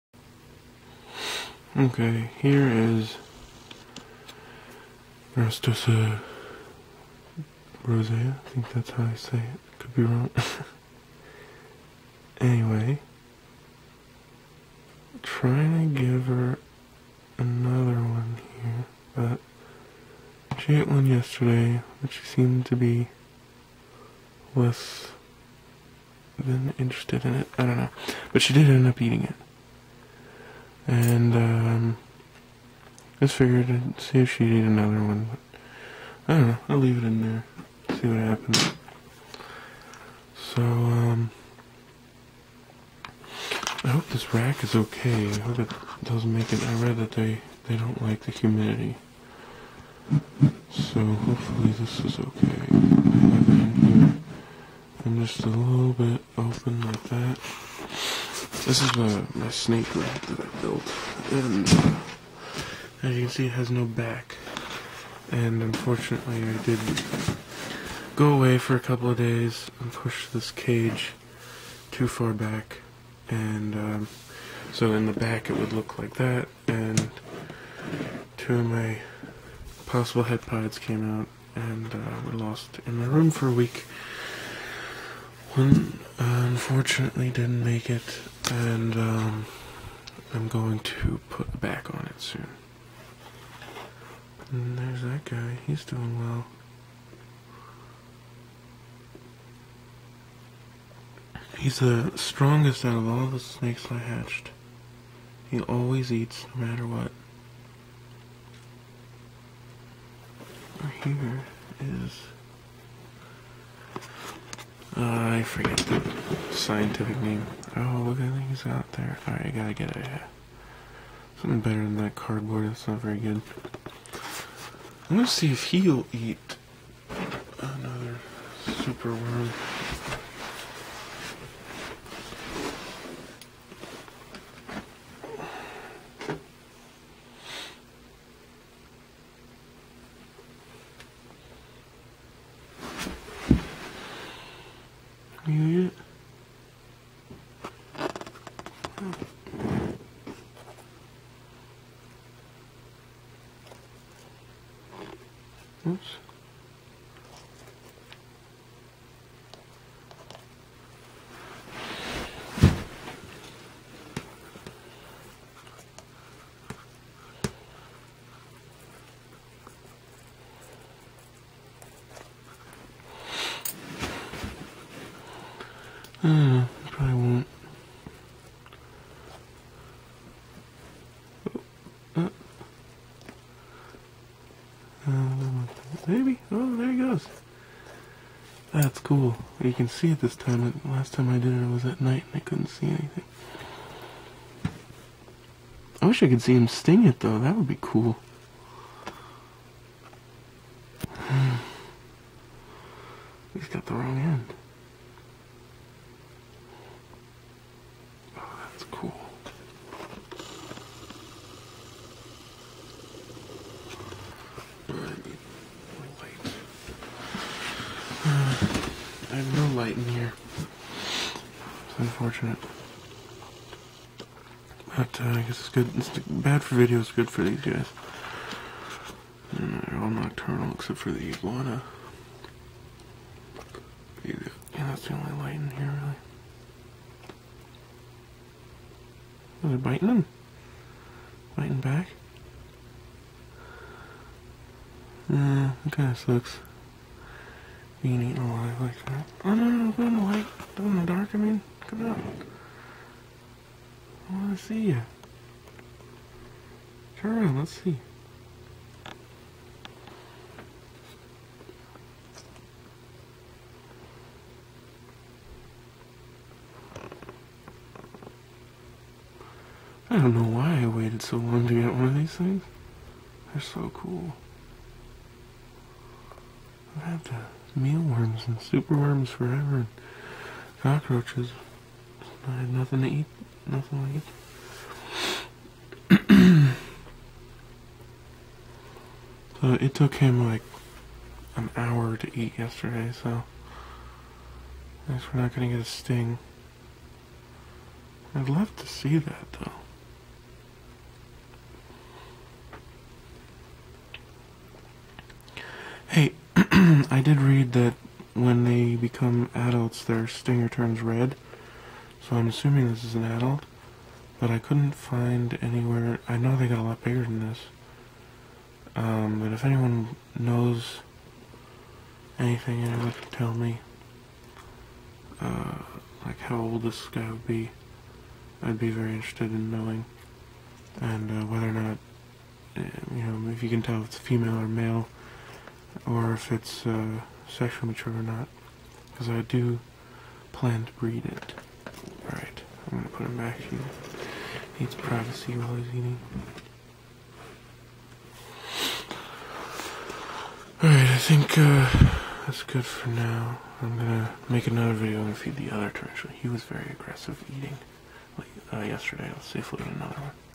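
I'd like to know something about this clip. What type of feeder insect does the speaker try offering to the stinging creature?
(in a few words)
super worm.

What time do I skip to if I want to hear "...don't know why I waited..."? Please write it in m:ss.
4:30.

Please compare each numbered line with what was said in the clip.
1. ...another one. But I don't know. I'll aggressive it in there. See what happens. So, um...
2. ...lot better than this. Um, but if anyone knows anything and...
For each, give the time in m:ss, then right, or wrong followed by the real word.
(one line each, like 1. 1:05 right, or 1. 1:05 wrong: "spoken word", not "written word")
1. 0:34 wrong: "leave", not "aggressive"
2. 5:16 wrong: "bigger", not "better".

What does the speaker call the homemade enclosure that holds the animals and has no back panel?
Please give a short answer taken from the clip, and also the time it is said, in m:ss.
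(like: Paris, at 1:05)
snake lab, at 0:59.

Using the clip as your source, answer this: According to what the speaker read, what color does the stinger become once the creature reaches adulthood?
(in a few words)
red.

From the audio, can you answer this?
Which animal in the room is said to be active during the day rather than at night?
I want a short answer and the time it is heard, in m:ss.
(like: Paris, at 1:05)
iguana, at 3:51.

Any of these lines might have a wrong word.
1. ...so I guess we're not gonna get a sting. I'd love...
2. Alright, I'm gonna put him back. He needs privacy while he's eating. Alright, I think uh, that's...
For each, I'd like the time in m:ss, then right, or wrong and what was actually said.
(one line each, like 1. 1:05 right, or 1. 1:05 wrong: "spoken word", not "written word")
1. 4:53 right
2. 5:42 right.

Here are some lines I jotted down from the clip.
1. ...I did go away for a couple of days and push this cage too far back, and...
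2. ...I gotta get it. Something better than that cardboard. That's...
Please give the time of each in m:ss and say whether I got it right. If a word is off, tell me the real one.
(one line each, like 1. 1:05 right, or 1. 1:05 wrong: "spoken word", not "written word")
1. 1:06 right
2. 1:59 right.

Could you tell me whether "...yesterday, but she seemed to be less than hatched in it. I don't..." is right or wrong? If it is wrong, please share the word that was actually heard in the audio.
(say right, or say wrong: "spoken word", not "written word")
wrong: "interested", not "hatched".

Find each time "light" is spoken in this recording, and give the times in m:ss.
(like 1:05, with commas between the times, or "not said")
3:39, 3:55, 4:10.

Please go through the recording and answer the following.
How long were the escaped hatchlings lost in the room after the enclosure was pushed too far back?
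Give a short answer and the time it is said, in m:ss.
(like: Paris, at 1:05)
a week, at 1:23.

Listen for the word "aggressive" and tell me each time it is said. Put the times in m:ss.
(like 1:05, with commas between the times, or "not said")
5:56.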